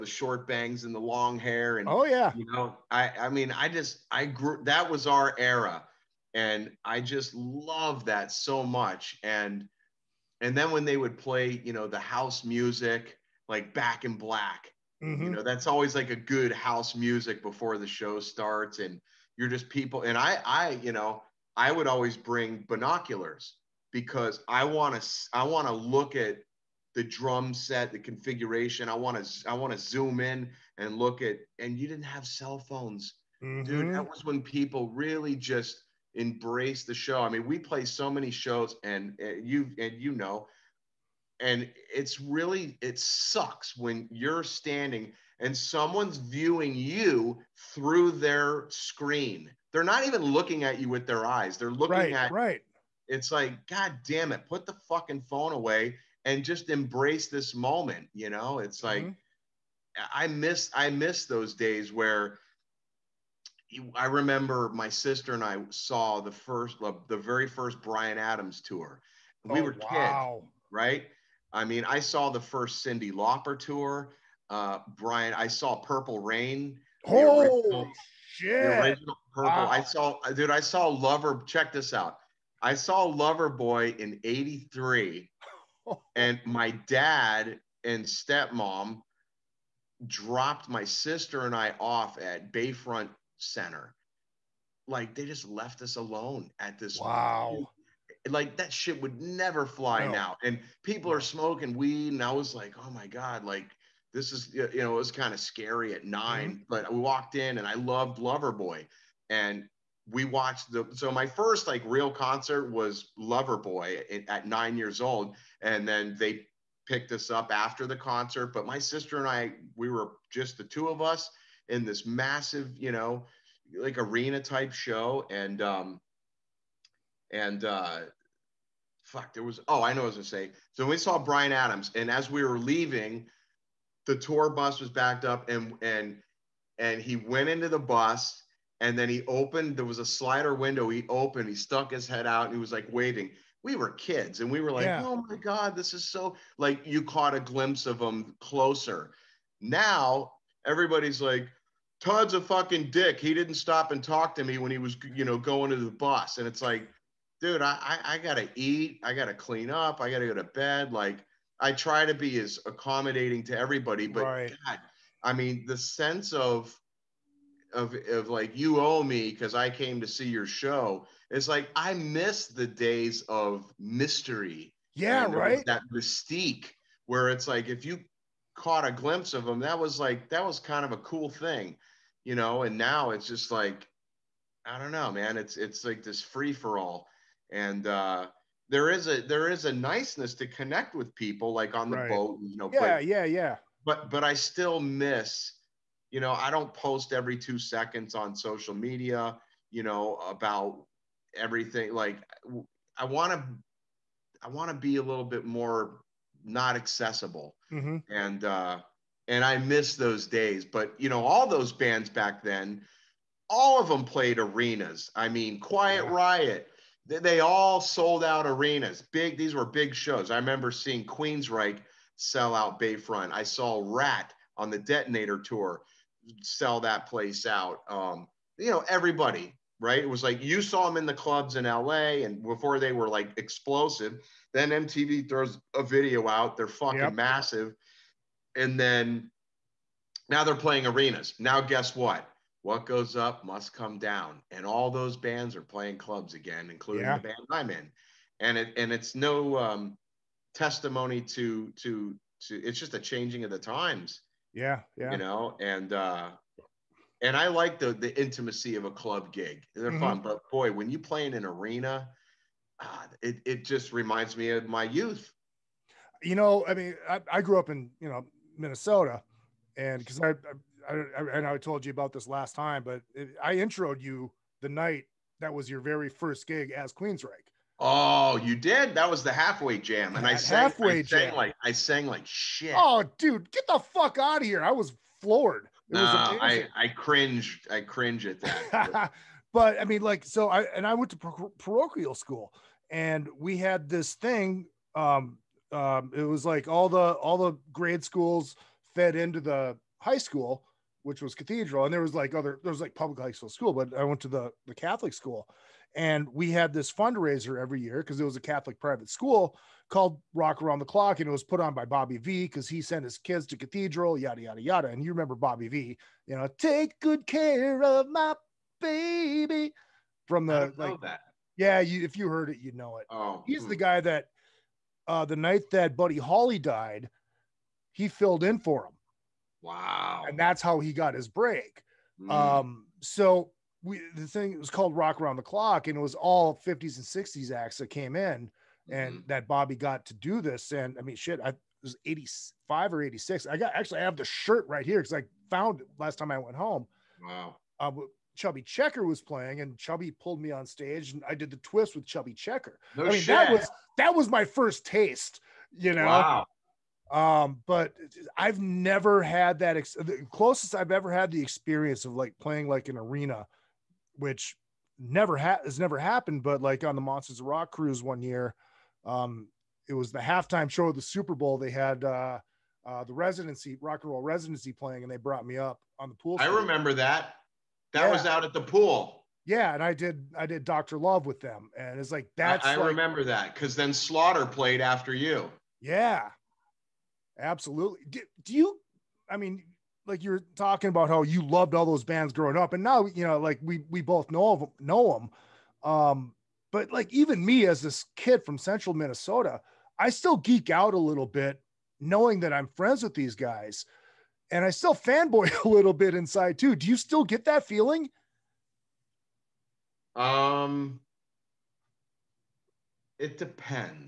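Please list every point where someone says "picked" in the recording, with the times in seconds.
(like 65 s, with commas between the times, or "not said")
116 s.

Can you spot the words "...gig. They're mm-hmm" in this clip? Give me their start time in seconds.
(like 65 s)
259 s.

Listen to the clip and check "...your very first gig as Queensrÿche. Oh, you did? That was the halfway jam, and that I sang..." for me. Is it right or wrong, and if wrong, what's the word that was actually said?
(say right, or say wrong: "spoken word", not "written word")
right.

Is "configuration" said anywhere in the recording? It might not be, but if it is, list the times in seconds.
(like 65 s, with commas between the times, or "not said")
27 s.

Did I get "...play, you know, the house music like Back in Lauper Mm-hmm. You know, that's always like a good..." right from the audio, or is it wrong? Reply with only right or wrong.
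wrong.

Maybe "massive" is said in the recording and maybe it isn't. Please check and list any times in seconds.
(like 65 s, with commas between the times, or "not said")
122 s, 237 s.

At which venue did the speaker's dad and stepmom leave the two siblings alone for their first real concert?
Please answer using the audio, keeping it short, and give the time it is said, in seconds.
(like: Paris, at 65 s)
Bayfront Center, at 92 s.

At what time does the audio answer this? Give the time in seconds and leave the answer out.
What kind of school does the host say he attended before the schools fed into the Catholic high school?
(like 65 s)
291 s.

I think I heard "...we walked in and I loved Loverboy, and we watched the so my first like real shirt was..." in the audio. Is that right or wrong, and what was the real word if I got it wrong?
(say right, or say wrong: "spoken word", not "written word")
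wrong: "concert", not "shirt".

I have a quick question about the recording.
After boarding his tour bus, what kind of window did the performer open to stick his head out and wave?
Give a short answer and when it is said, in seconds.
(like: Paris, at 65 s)
slider window, at 140 s.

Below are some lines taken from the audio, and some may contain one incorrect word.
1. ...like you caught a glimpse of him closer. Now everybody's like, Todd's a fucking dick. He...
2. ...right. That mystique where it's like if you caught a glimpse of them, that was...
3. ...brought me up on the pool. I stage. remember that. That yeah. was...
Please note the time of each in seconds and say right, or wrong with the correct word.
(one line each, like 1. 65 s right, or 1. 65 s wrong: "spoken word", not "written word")
1. 146 s right
2. 175 s right
3. 375 s right.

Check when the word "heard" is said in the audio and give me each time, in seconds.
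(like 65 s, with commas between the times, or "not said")
322 s.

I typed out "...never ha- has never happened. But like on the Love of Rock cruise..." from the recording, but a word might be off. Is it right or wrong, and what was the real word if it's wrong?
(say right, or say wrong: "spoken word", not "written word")
wrong: "Monsters", not "Love".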